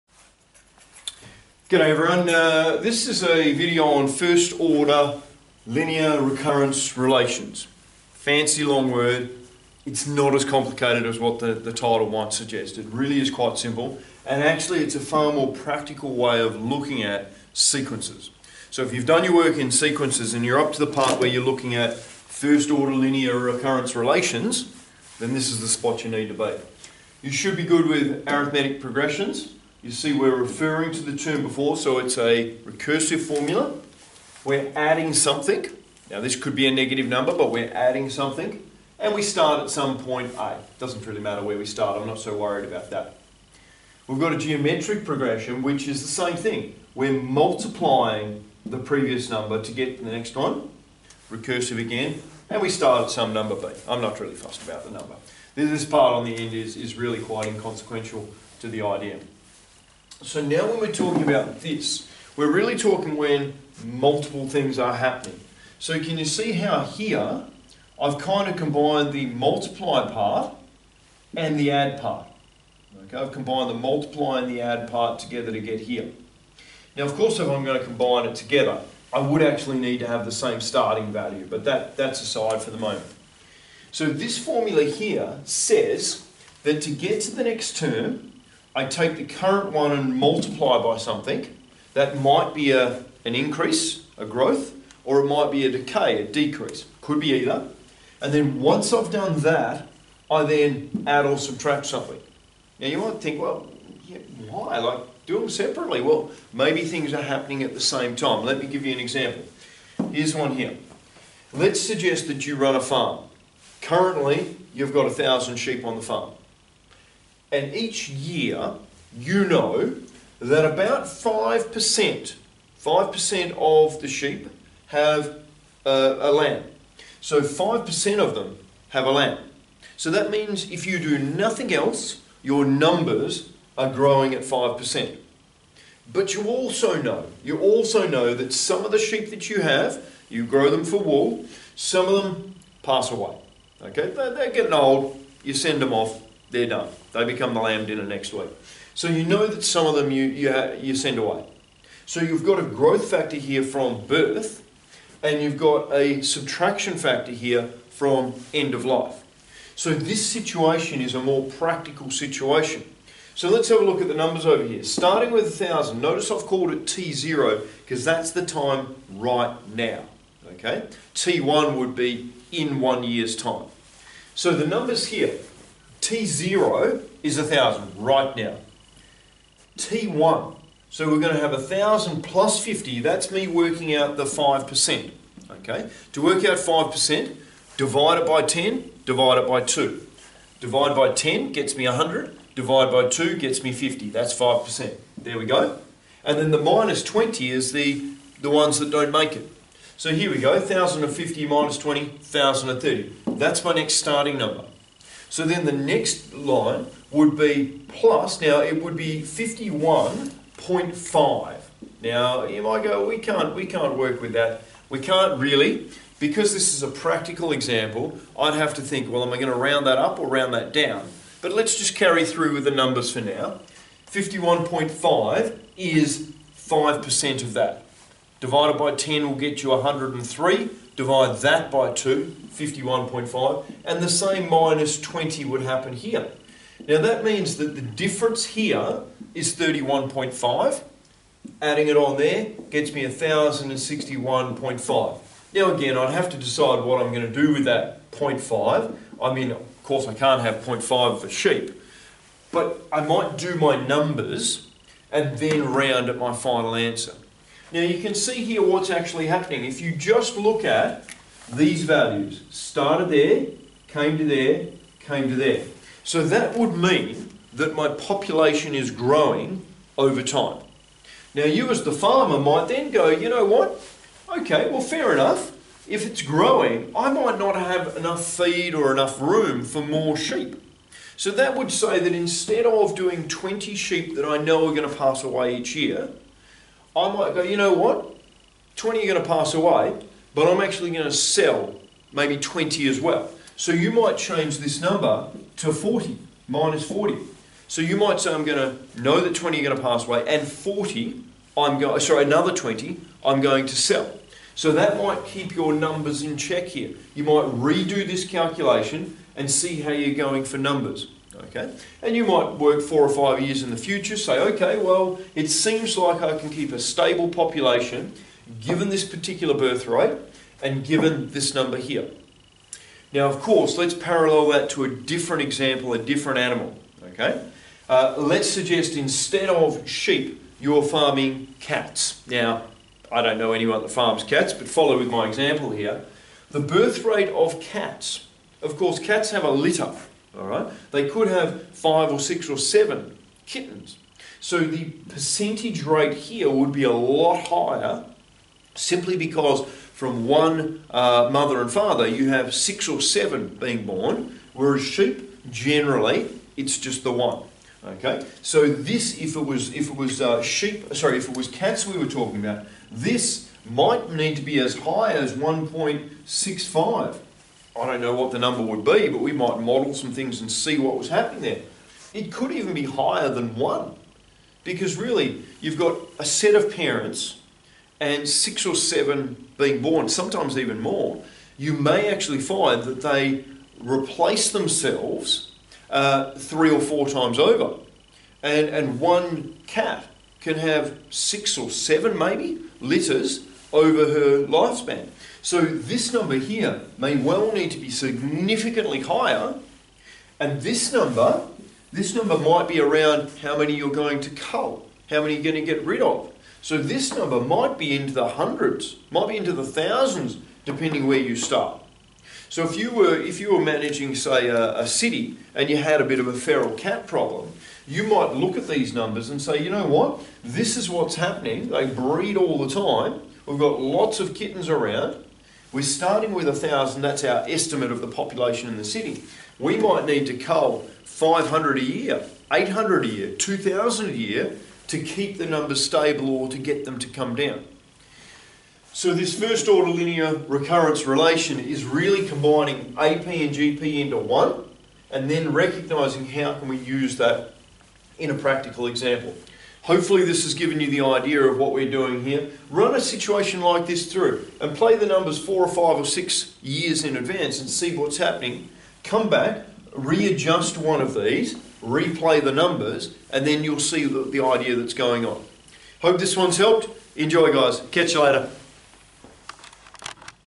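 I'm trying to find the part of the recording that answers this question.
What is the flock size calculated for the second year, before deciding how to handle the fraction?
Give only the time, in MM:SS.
04:03.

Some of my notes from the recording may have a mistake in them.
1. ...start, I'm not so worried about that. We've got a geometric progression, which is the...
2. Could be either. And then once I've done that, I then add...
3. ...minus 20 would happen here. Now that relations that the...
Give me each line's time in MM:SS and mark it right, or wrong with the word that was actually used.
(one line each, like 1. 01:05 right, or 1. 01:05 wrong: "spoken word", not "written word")
1. 00:41 right
2. 01:37 right
3. 03:54 wrong: "means", not "relations".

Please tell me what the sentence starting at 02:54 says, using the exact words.
So the numbers here, T0 is a 1,000 right now.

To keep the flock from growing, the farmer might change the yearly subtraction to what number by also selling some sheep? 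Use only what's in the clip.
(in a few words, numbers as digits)
40.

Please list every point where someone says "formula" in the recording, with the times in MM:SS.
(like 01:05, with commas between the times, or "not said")
00:33, 01:24.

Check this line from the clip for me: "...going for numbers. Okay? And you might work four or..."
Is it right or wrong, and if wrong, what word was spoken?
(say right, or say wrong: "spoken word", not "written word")
right.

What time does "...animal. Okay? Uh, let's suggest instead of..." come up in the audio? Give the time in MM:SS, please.
05:26.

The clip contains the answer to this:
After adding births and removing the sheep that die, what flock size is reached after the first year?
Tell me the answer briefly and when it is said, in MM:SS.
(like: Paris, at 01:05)
1,030, at 03:22.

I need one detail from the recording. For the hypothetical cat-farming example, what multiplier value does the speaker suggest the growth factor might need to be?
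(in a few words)
1.65.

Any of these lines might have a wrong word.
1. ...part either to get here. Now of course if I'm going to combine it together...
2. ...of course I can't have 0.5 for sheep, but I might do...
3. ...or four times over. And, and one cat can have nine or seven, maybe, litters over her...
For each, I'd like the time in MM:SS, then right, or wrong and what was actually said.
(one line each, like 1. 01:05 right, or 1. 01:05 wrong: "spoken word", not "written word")
1. 01:14 wrong: "together", not "either"
2. 04:09 right
3. 06:26 wrong: "six", not "nine".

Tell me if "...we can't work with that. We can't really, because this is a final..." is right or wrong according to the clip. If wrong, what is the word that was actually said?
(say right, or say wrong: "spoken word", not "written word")
wrong: "practical", not "final".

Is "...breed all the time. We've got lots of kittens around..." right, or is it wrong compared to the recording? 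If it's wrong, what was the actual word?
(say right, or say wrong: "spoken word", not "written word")
right.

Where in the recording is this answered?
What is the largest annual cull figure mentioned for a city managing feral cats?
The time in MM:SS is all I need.
07:13.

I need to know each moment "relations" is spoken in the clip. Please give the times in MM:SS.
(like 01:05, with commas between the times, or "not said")
00:06, 00:23, 07:21.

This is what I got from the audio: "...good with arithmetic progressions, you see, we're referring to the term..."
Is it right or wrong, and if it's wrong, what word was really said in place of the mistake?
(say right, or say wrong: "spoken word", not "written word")
right.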